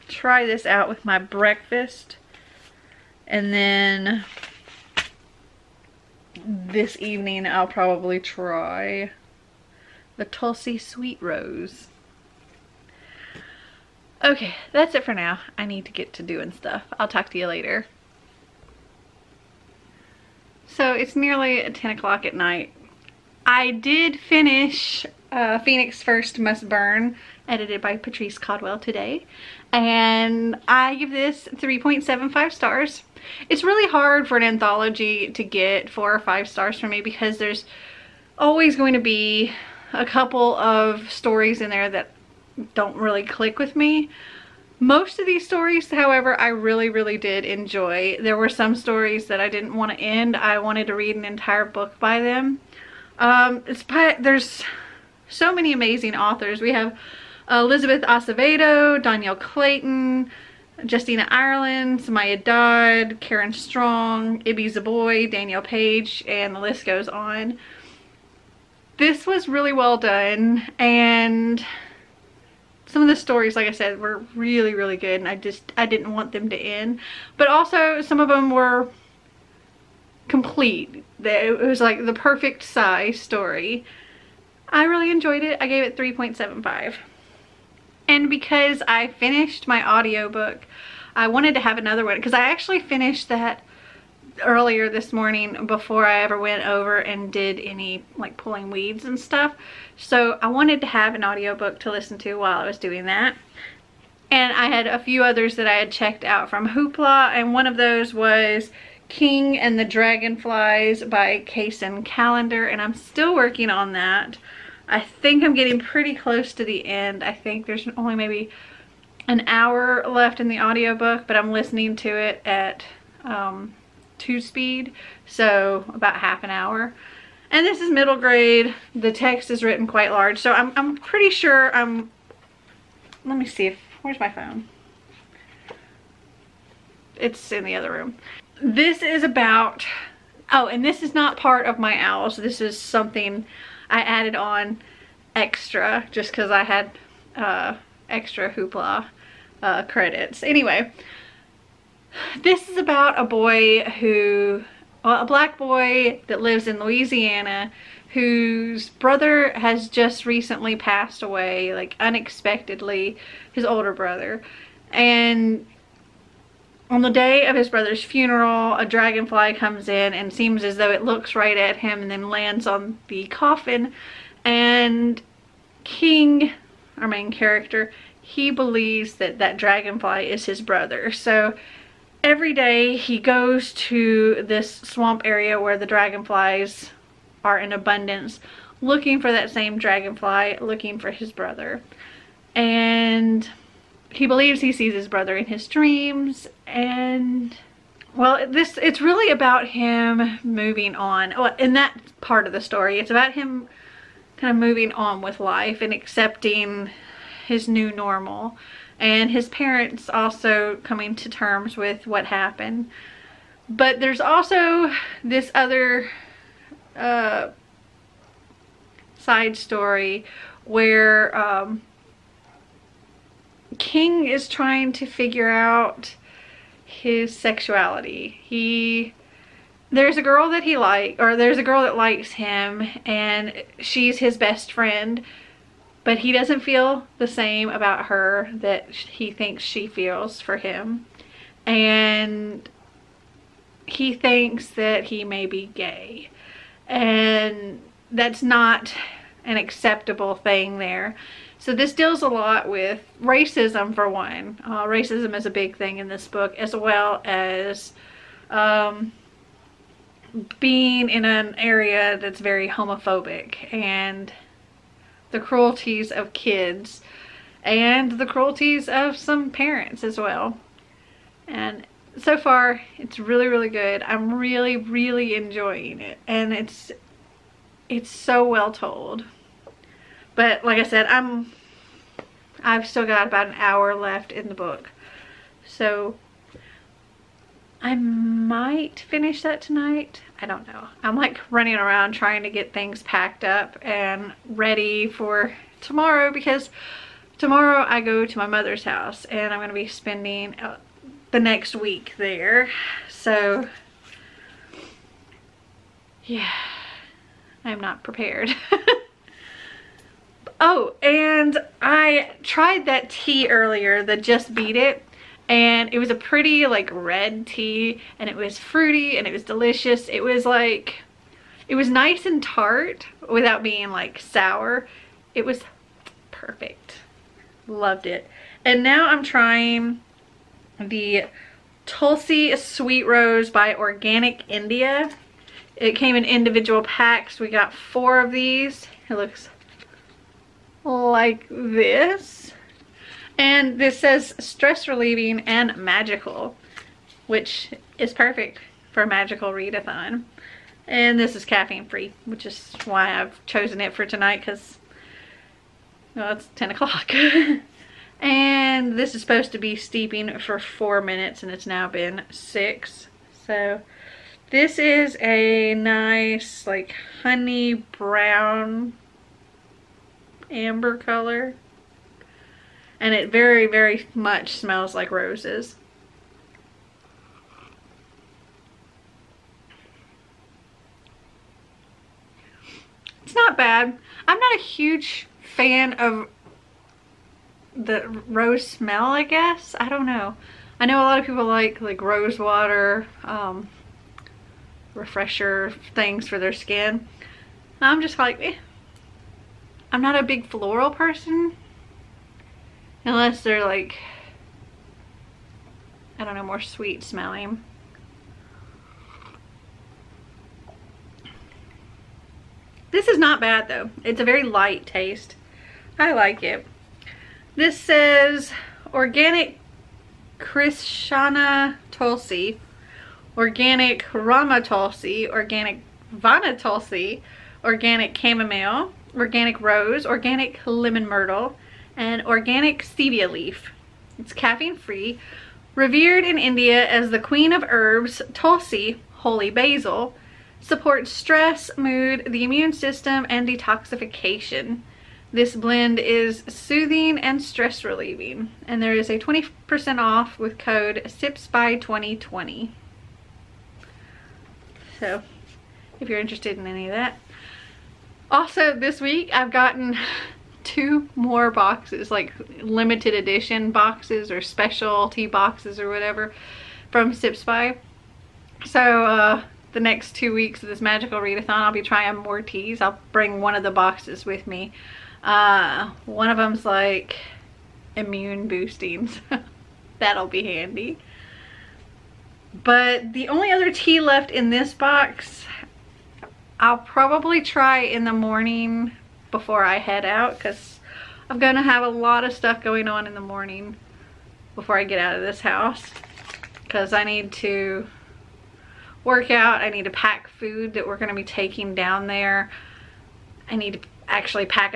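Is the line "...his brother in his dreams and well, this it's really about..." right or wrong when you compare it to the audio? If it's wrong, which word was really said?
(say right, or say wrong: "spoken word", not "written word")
right.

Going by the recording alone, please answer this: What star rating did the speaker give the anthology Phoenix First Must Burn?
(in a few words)
3.75.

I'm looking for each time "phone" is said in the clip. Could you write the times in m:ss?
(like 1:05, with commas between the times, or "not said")
2:14.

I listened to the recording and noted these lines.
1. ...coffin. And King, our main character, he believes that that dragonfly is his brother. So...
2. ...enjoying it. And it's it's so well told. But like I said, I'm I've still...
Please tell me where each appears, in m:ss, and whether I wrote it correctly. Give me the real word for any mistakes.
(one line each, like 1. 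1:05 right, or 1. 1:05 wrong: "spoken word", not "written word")
1. 2:53 right
2. 4:35 right.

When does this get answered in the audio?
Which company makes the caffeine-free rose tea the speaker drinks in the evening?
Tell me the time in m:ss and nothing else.
5:33.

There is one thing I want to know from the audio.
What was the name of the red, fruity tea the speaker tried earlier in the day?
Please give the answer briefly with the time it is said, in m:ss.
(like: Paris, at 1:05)
Just Beat It, at 5:14.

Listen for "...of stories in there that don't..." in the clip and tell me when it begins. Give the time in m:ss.
0:40.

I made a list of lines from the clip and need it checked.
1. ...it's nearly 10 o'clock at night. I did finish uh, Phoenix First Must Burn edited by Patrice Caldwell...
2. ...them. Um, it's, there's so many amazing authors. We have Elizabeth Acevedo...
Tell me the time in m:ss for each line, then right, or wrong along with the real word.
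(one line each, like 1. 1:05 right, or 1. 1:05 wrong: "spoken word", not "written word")
1. 0:20 right
2. 0:52 right.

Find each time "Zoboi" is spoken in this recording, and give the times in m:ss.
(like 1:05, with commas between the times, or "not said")
1:04.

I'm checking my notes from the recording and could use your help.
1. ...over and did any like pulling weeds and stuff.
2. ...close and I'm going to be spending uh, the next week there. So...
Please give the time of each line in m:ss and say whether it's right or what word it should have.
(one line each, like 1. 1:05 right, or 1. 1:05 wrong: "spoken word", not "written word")
1. 1:36 right
2. 4:58 wrong: "house", not "close".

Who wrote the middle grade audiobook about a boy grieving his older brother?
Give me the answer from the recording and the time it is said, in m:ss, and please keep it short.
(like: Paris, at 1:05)
Kacen Callender, at 1:51.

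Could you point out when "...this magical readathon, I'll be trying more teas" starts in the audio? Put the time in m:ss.
7:50.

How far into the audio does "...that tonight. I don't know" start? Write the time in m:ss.
4:49.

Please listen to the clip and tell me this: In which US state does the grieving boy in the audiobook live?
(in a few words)
Louisiana.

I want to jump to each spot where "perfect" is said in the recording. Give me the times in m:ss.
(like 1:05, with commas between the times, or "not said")
1:22, 5:26, 5:48.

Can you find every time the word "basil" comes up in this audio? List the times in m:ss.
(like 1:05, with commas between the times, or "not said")
7:19.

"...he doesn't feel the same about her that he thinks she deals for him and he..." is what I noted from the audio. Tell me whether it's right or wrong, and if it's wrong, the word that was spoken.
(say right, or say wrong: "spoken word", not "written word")
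wrong: "feels", not "deals".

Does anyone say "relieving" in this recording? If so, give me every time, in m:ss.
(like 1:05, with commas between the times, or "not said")
5:44, 7:27.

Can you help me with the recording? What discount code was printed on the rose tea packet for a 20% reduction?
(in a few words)
SIPSBY2020.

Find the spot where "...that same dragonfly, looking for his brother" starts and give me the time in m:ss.
3:09.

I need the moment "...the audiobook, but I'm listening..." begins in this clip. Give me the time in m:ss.
2:00.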